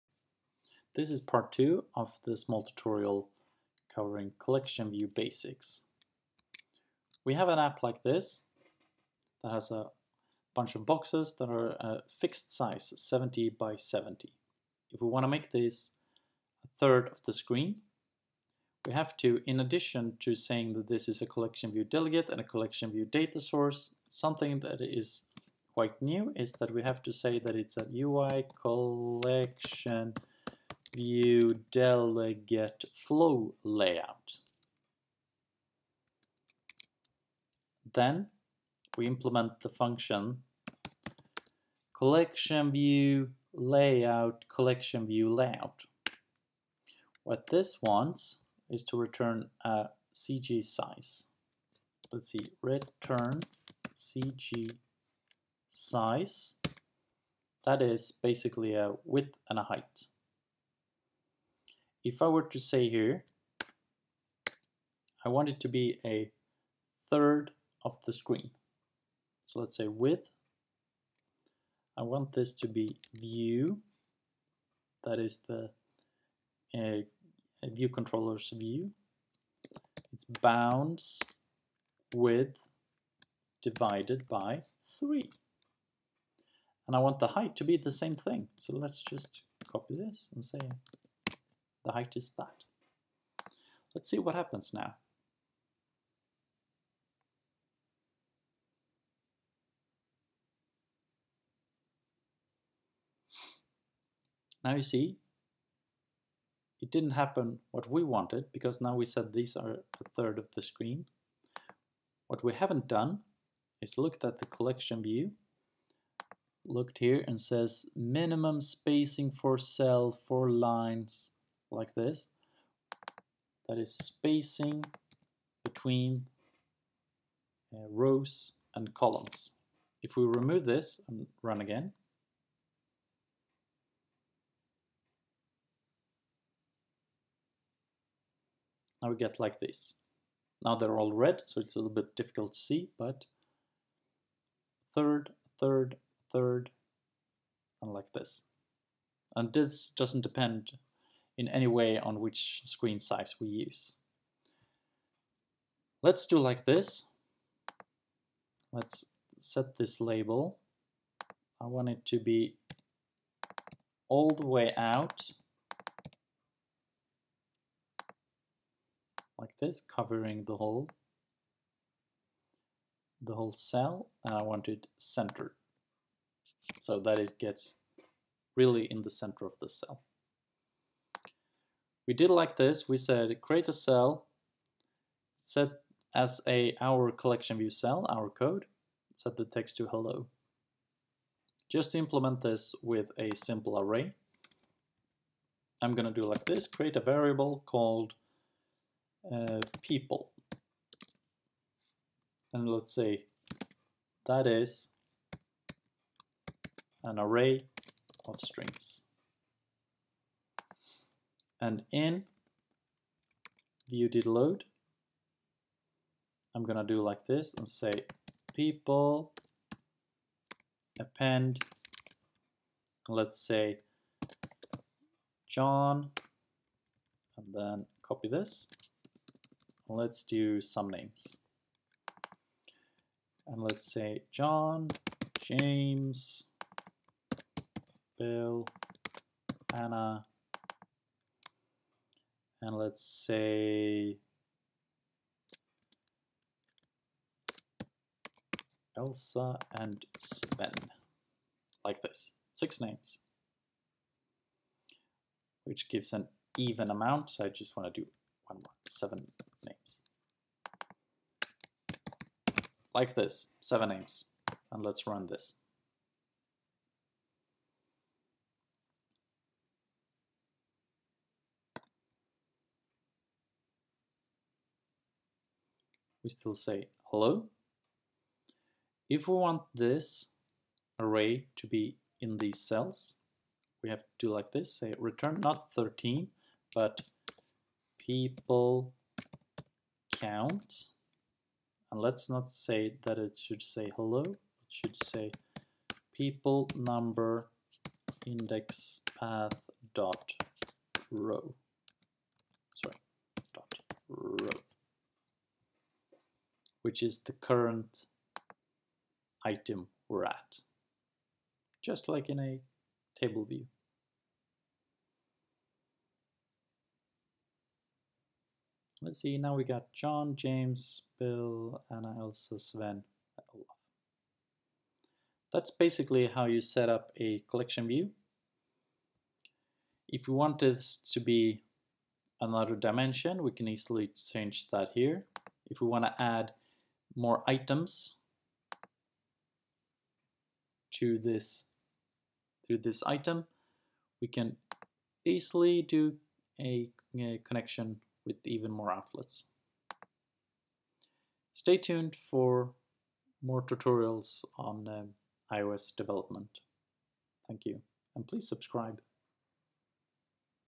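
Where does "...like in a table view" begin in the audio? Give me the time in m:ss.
5:12.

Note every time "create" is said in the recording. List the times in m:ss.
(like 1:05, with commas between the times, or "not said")
3:03, 3:16.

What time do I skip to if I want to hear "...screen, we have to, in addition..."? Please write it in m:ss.
0:17.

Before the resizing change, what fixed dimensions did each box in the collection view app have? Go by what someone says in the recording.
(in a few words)
70 by 70.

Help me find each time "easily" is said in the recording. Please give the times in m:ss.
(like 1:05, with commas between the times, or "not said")
5:33, 5:45.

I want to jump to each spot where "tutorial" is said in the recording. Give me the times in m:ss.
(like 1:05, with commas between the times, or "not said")
0:02, 5:53.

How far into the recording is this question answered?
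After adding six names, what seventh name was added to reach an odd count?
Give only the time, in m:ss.
5:23.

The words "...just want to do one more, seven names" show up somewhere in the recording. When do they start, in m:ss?
4:17.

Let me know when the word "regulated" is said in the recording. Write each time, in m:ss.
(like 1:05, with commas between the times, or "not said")
not said.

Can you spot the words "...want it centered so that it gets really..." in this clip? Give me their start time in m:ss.
2:54.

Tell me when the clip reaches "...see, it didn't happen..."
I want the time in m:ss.
1:44.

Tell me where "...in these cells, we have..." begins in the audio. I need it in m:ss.
4:42.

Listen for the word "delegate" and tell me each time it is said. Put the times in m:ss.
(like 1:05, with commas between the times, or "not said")
0:21, 0:31.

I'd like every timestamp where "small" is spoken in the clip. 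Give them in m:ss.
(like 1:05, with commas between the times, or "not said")
0:02.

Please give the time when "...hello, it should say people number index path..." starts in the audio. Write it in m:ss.
4:53.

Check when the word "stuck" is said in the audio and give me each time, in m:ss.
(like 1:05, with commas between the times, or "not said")
not said.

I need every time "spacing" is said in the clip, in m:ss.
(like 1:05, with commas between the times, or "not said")
1:58, 2:03.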